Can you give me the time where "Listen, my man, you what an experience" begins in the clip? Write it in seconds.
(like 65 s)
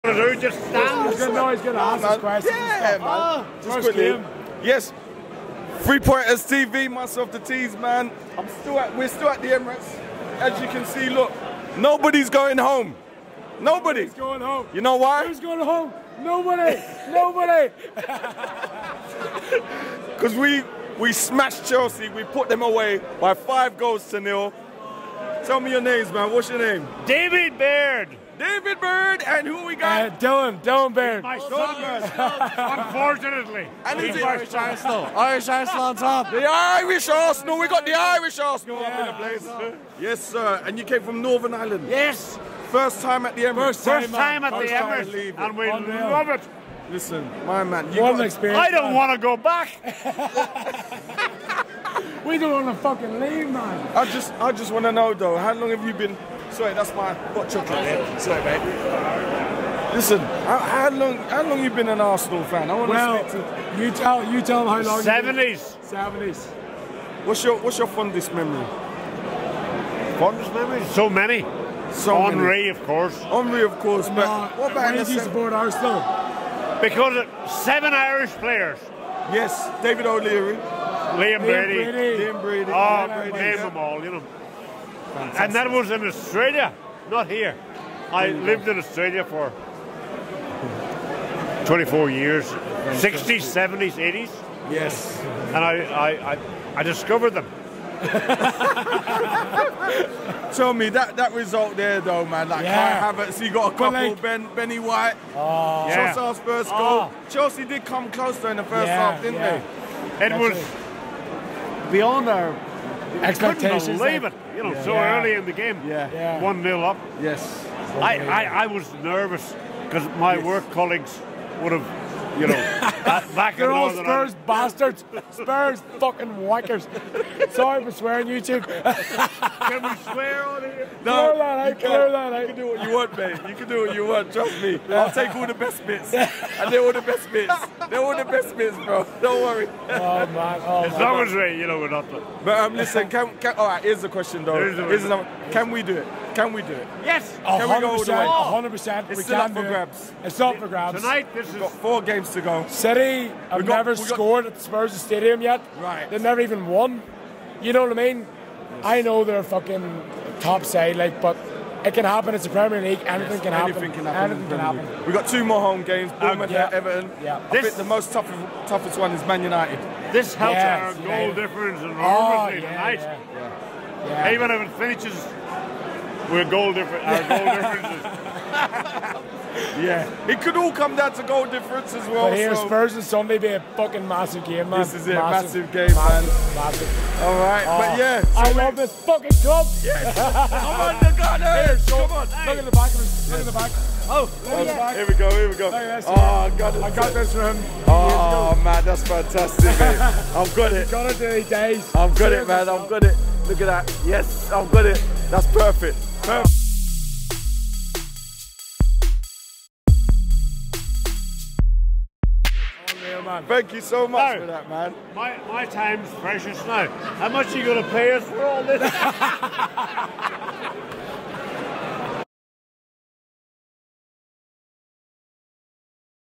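46 s.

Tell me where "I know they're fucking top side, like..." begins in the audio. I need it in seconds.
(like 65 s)
158 s.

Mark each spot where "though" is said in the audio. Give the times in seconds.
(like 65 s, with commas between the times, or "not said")
55 s, 102 s, 144 s.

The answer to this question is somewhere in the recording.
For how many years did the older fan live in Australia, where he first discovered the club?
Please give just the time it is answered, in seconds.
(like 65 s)
91 s.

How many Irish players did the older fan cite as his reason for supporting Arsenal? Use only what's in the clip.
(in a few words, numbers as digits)
7.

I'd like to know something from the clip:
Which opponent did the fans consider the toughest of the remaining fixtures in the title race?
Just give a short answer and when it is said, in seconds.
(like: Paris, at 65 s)
Man United, at 169 s.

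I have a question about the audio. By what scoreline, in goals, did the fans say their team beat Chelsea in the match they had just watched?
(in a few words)
5-0.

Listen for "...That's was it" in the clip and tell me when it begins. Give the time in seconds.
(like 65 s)
110 s.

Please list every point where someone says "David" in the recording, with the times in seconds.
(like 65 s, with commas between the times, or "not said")
27 s, 79 s.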